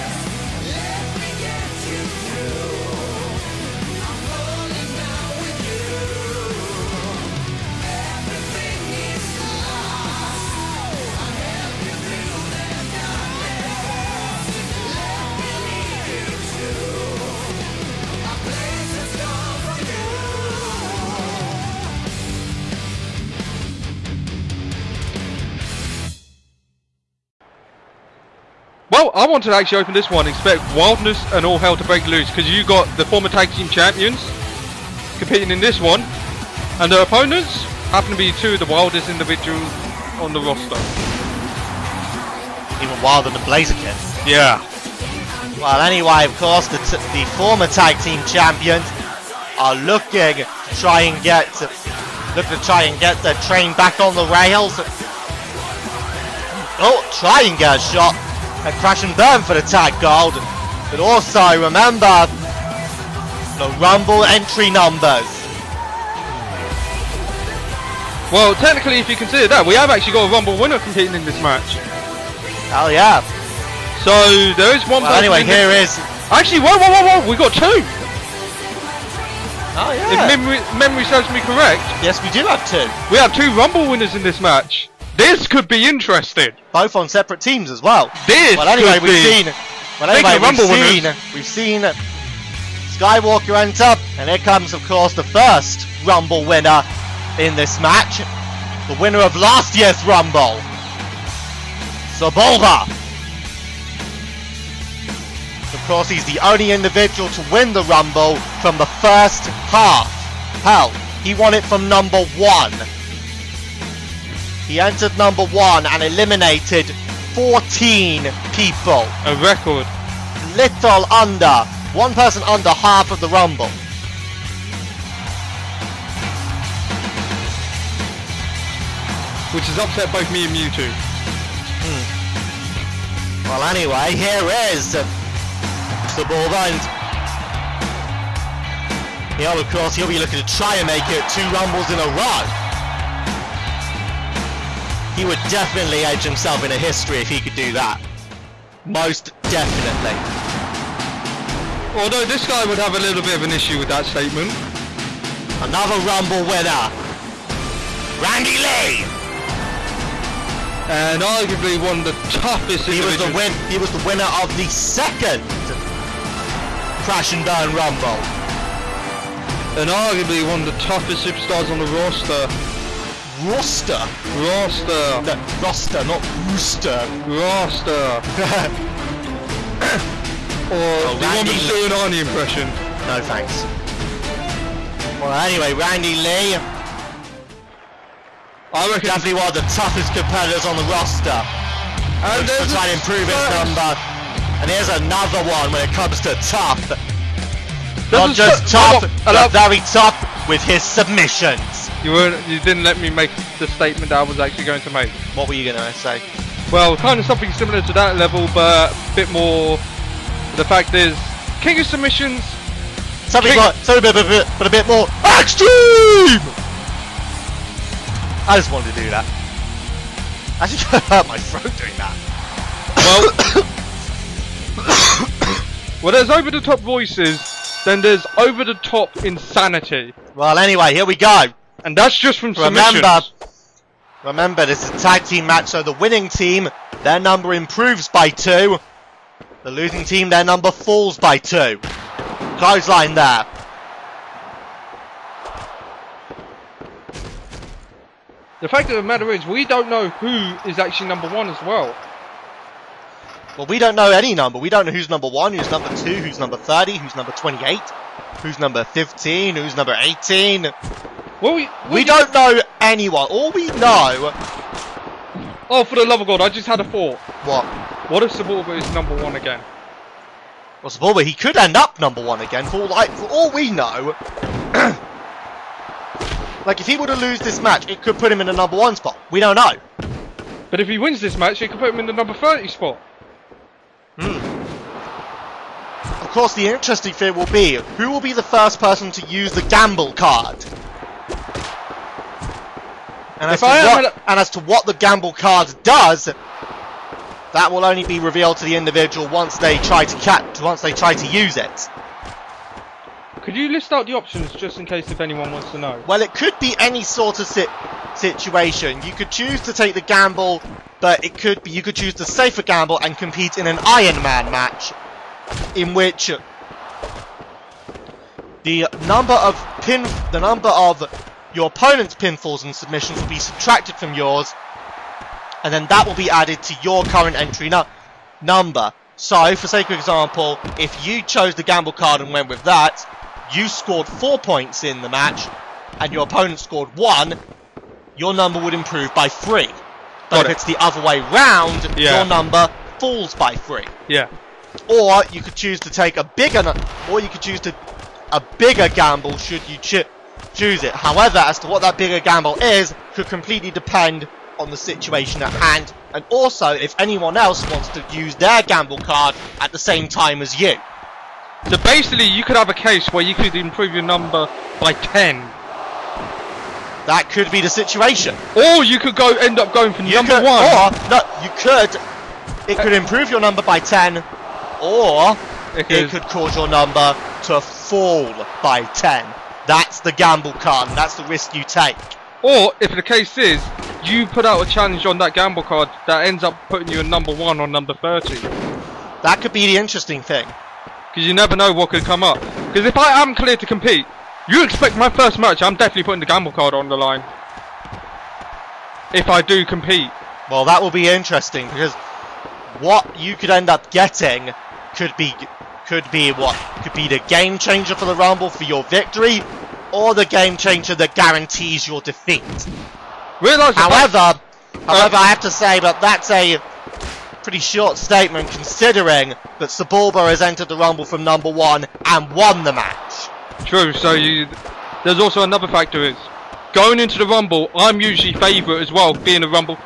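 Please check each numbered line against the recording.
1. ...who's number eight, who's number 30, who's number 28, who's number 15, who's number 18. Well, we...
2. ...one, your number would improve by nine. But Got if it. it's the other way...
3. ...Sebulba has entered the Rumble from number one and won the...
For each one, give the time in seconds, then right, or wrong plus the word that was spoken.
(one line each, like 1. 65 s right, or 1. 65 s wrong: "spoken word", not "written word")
1. 255 s wrong: "two", not "eight"
2. 336 s wrong: "three", not "nine"
3. 419 s right.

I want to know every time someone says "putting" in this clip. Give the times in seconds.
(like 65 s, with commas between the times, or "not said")
386 s, 396 s.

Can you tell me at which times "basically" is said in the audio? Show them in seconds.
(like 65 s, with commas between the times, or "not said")
361 s.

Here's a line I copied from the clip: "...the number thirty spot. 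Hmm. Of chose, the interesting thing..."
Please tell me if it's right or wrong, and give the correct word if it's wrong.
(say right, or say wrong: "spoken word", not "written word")
wrong: "course", not "chose".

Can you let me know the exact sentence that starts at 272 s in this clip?
For like, for all we know.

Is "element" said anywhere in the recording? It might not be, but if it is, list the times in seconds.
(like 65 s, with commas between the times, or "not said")
not said.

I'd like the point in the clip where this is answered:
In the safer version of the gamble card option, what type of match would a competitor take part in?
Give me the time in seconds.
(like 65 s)
313 s.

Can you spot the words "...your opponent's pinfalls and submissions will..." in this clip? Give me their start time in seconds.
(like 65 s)
321 s.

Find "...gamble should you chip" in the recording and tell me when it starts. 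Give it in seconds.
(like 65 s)
348 s.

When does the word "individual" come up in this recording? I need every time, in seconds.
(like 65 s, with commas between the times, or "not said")
39 s, 106 s, 298 s.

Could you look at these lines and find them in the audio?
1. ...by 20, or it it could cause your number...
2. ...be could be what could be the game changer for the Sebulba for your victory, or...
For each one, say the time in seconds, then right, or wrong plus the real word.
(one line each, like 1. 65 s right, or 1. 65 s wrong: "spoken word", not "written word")
1. 373 s wrong: "10", not "20"
2. 405 s wrong: "Rumble", not "Sebulba".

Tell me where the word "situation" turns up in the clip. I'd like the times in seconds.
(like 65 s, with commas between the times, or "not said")
308 s, 354 s, 367 s.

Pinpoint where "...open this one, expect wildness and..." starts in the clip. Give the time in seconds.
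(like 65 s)
29 s.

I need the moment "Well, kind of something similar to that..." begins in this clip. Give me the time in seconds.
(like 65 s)
206 s.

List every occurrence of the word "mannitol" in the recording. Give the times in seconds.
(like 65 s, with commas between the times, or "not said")
not said.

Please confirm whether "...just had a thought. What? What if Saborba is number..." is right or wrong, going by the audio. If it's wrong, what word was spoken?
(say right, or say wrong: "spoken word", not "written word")
right.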